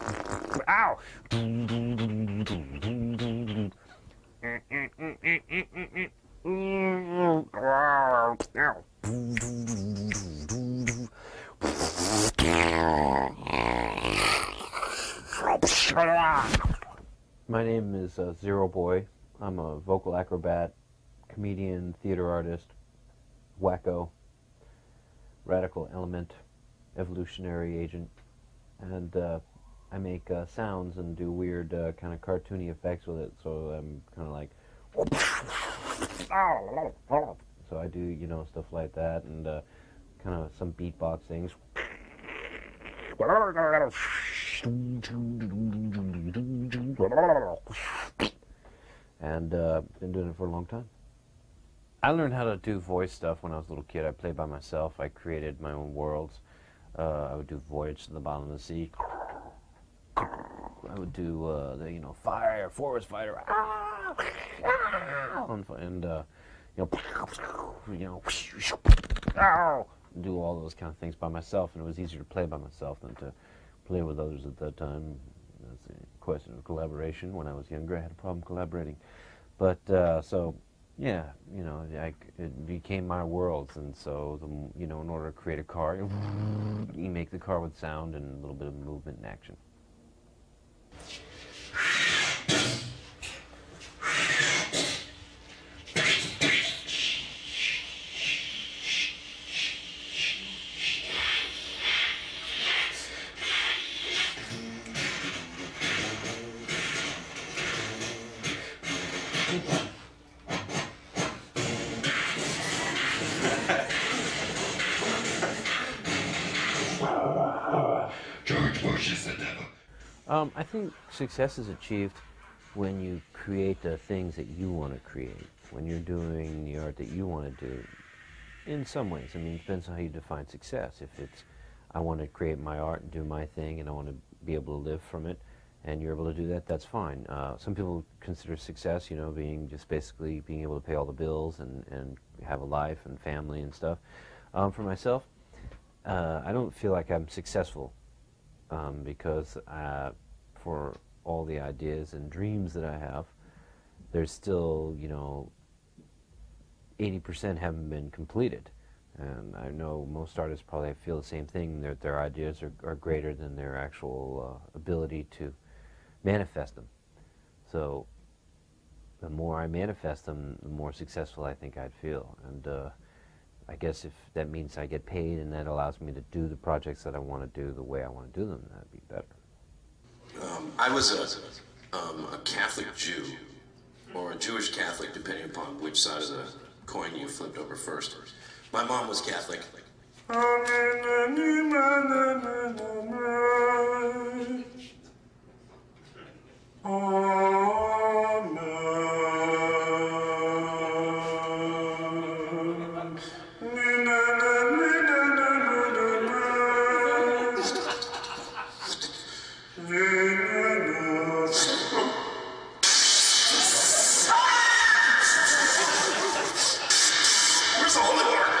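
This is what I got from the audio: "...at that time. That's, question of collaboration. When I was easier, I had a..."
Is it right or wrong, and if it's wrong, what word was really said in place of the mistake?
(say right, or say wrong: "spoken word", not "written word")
wrong: "younger", not "easier".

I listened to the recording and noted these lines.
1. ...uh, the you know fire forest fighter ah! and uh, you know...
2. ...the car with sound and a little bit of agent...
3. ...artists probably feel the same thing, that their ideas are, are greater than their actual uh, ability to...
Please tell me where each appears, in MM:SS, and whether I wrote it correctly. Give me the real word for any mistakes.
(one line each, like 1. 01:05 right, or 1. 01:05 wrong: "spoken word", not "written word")
1. 01:01 right
2. 01:27 wrong: "movement", not "agent"
3. 02:40 right.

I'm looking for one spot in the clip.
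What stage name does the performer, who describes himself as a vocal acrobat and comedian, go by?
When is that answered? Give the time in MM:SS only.
00:18.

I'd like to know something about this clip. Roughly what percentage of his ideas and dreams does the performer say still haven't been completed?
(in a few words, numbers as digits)
80%.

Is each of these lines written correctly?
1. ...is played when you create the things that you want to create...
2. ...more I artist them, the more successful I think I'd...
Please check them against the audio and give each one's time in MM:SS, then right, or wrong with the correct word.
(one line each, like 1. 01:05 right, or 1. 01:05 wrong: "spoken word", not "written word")
1. 02:01 wrong: "achieved", not "played"
2. 02:49 wrong: "manifest", not "artist".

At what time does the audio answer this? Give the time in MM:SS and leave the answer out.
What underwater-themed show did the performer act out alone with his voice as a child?
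00:57.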